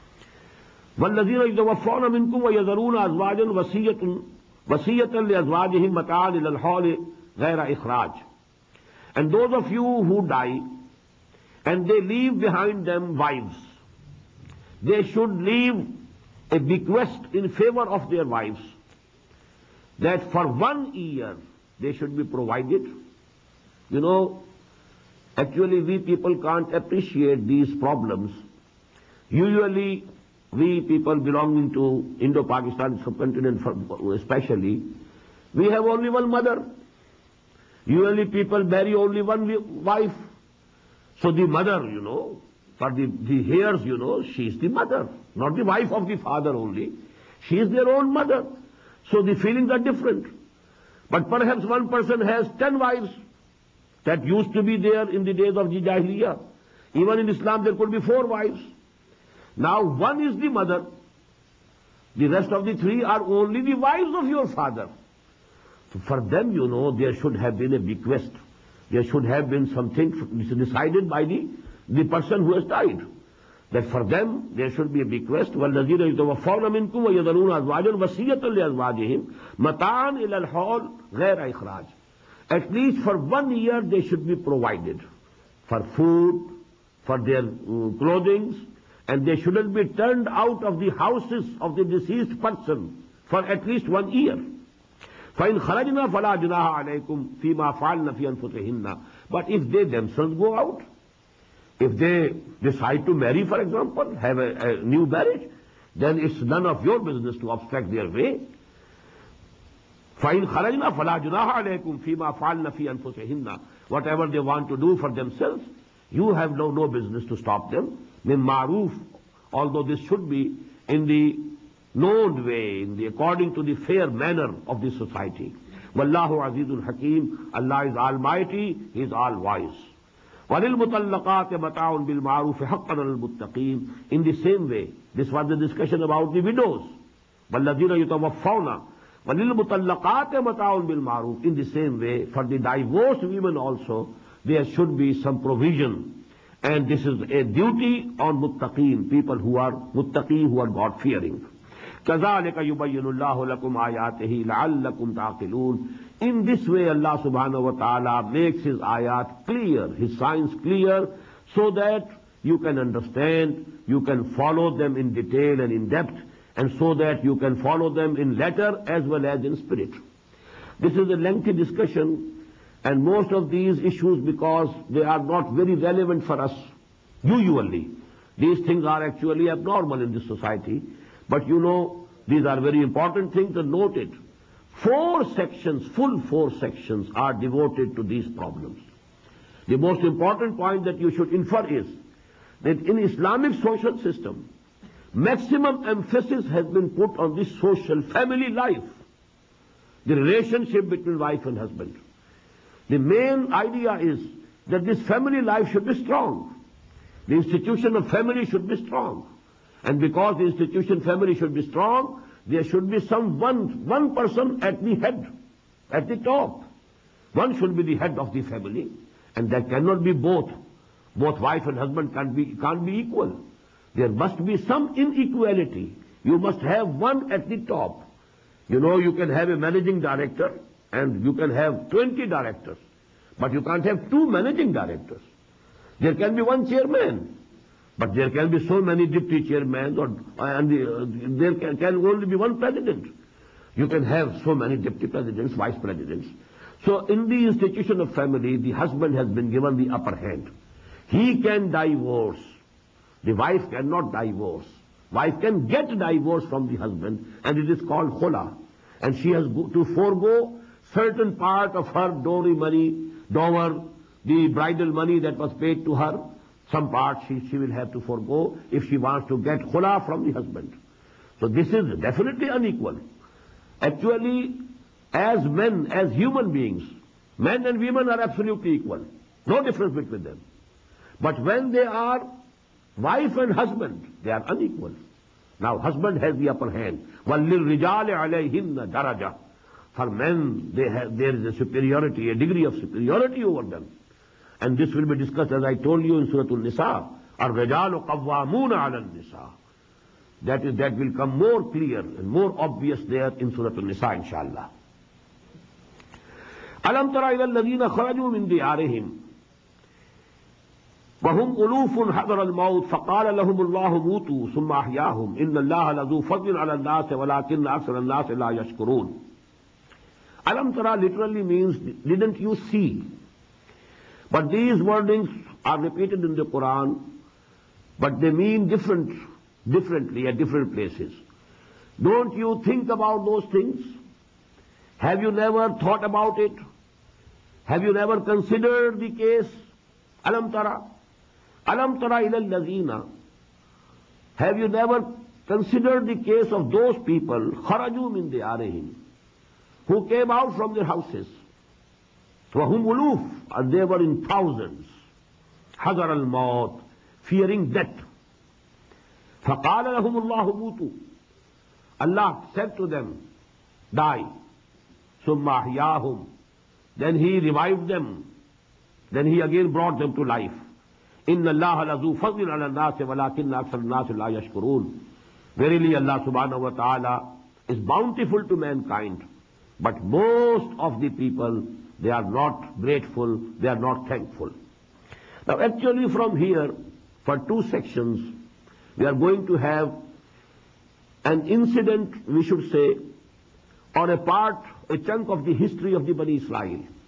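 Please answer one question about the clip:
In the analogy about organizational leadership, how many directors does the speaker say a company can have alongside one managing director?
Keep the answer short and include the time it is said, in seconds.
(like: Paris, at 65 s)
20, at 231 s.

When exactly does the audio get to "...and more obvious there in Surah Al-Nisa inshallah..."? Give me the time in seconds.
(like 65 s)
301 s.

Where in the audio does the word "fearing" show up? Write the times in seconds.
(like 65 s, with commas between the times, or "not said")
150 s, 357 s.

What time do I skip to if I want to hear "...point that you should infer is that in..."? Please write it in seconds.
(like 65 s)
190 s.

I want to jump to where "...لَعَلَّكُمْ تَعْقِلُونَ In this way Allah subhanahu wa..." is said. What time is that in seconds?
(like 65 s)
154 s.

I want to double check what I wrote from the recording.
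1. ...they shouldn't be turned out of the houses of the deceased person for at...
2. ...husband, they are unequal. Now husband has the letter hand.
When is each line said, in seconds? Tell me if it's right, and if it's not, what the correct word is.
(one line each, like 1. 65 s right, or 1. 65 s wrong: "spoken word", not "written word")
1. 89 s right
2. 283 s wrong: "upper", not "letter".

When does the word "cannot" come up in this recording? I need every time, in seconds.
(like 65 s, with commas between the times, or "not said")
219 s, 253 s.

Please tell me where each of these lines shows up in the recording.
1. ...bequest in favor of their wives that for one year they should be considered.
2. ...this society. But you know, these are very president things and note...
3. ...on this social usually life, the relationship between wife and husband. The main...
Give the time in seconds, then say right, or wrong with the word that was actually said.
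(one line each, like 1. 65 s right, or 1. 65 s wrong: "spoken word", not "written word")
1. 16 s wrong: "provided", not "considered"
2. 180 s wrong: "important", not "president"
3. 197 s wrong: "family", not "usually".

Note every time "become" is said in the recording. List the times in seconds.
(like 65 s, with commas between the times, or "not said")
not said.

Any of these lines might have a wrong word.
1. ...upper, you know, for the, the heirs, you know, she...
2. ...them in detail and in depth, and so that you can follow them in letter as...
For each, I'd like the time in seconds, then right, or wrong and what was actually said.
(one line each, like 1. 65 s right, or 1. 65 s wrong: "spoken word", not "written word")
1. 41 s wrong: "mother", not "upper"
2. 164 s right.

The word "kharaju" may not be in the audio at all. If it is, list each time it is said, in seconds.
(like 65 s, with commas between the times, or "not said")
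307 s, 347 s.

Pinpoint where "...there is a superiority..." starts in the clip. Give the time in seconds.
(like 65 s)
291 s.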